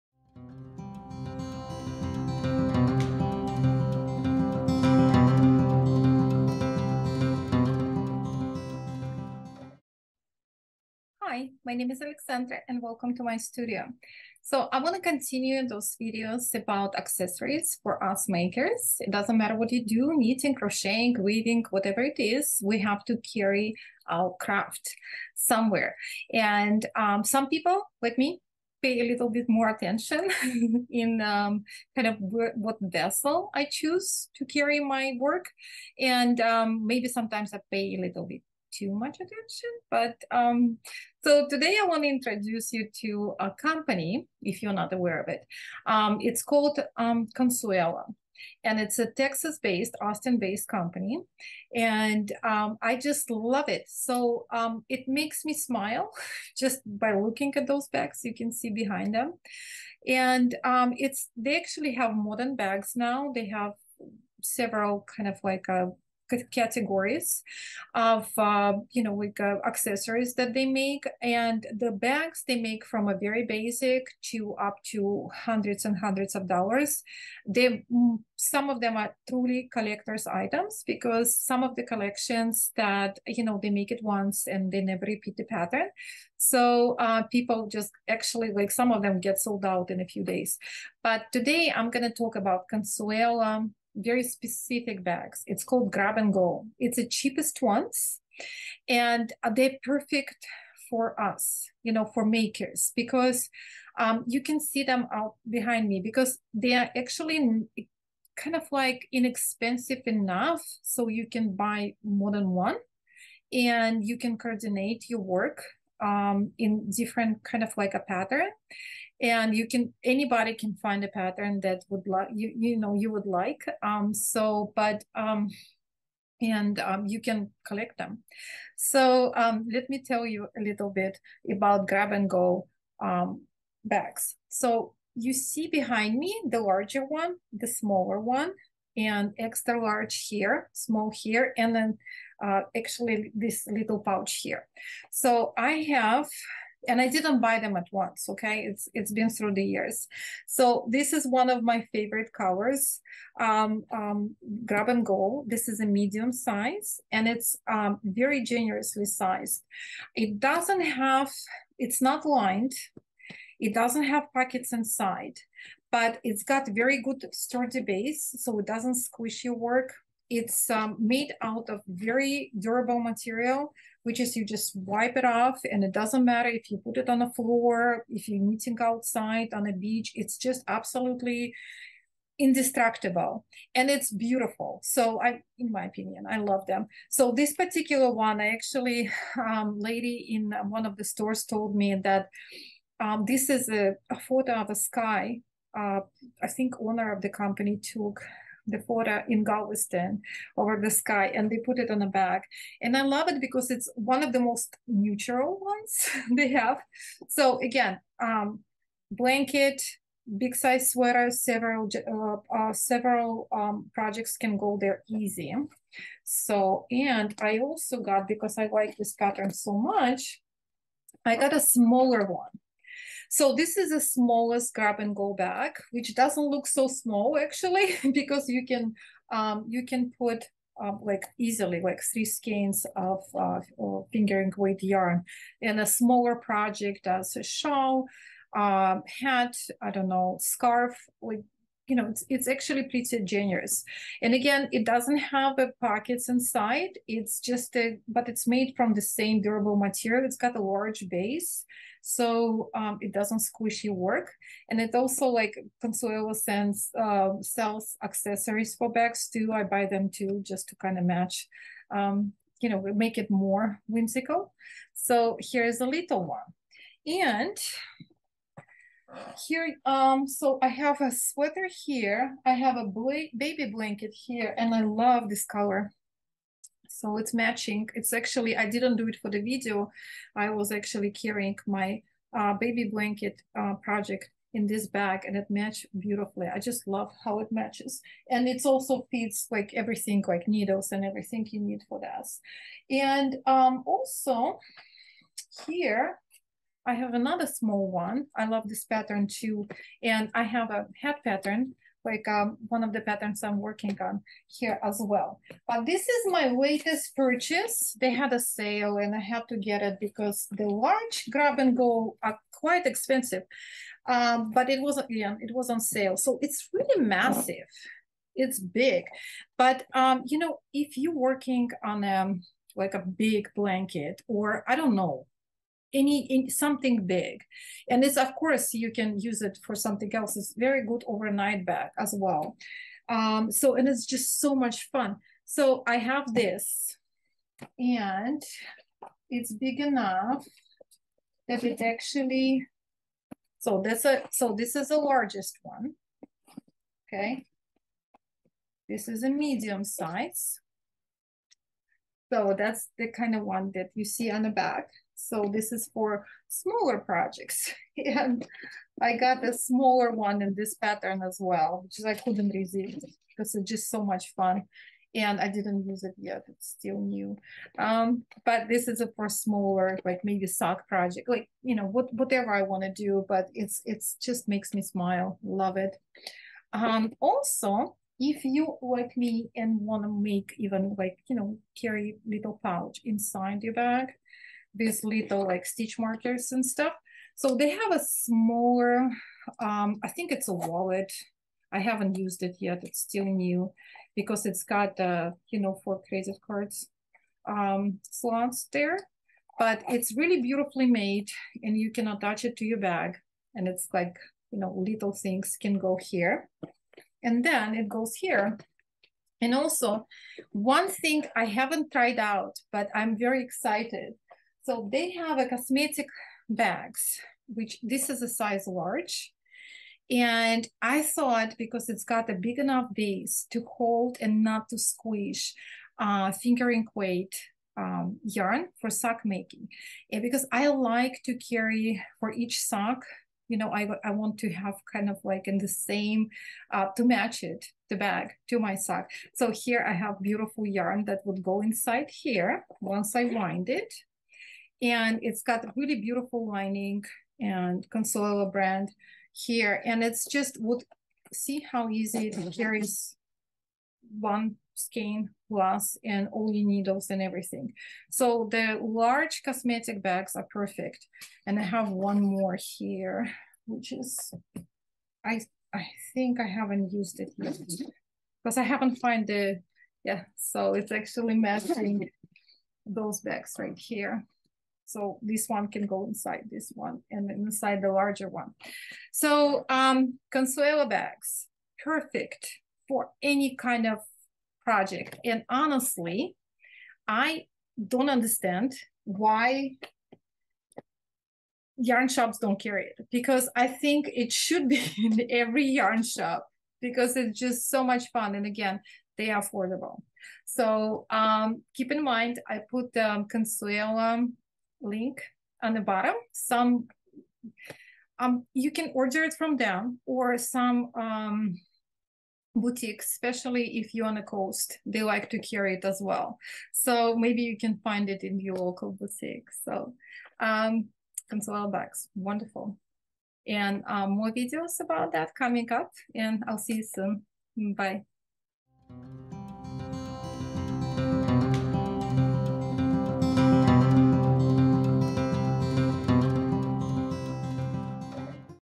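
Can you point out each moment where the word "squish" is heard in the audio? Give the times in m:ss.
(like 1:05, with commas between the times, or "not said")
2:48, 4:13, 7:04.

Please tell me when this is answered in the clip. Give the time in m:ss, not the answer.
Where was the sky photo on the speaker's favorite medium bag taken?
3:19.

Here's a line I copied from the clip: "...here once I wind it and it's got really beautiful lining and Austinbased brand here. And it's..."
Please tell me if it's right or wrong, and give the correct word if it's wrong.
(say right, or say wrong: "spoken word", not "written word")
wrong: "Consuela", not "Austinbased".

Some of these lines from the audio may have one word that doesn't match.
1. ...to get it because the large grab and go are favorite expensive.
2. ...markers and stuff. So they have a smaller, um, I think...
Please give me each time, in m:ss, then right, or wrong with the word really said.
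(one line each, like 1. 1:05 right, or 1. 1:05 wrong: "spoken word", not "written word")
1. 5:09 wrong: "quite", not "favorite"
2. 6:25 right.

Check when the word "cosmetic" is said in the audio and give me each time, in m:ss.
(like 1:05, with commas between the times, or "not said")
6:55, 7:39.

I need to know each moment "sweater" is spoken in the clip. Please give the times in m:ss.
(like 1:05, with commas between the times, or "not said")
3:30, 4:31.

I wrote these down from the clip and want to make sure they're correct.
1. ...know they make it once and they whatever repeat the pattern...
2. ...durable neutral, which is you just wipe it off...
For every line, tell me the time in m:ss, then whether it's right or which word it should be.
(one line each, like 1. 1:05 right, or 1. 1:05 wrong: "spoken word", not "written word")
1. 1:23 wrong: "never", not "whatever"
2. 2:52 wrong: "material", not "neutral".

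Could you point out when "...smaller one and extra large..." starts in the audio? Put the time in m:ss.
2:17.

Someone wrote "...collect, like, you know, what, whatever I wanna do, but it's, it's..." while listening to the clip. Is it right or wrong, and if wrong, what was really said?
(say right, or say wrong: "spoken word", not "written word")
wrong: "project", not "collect".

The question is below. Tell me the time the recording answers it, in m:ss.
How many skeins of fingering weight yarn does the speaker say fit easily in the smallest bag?
3:52.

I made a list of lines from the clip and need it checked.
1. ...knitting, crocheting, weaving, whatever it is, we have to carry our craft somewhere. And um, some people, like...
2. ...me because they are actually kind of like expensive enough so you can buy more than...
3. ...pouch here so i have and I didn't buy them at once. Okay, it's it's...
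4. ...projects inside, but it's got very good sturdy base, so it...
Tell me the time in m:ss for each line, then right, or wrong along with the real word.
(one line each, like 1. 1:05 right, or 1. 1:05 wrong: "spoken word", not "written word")
1. 0:20 right
2. 1:45 wrong: "inexpensive", not "expensive"
3. 2:23 right
4. 2:44 wrong: "pockets", not "projects".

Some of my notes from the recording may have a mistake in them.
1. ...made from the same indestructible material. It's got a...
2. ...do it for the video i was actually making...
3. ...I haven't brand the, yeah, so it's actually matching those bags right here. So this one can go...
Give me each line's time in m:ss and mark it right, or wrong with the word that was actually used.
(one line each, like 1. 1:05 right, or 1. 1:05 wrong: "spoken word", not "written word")
1. 4:08 wrong: "durable", not "indestructible"
2. 4:38 wrong: "carrying", not "making"
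3. 7:48 wrong: "found", not "brand".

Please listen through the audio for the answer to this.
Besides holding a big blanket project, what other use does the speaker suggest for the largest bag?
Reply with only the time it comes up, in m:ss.
5:31.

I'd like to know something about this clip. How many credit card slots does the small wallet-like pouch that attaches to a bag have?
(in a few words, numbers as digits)
4.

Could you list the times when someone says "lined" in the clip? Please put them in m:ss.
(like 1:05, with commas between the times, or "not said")
2:42.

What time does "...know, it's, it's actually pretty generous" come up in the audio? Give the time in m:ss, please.
4:01.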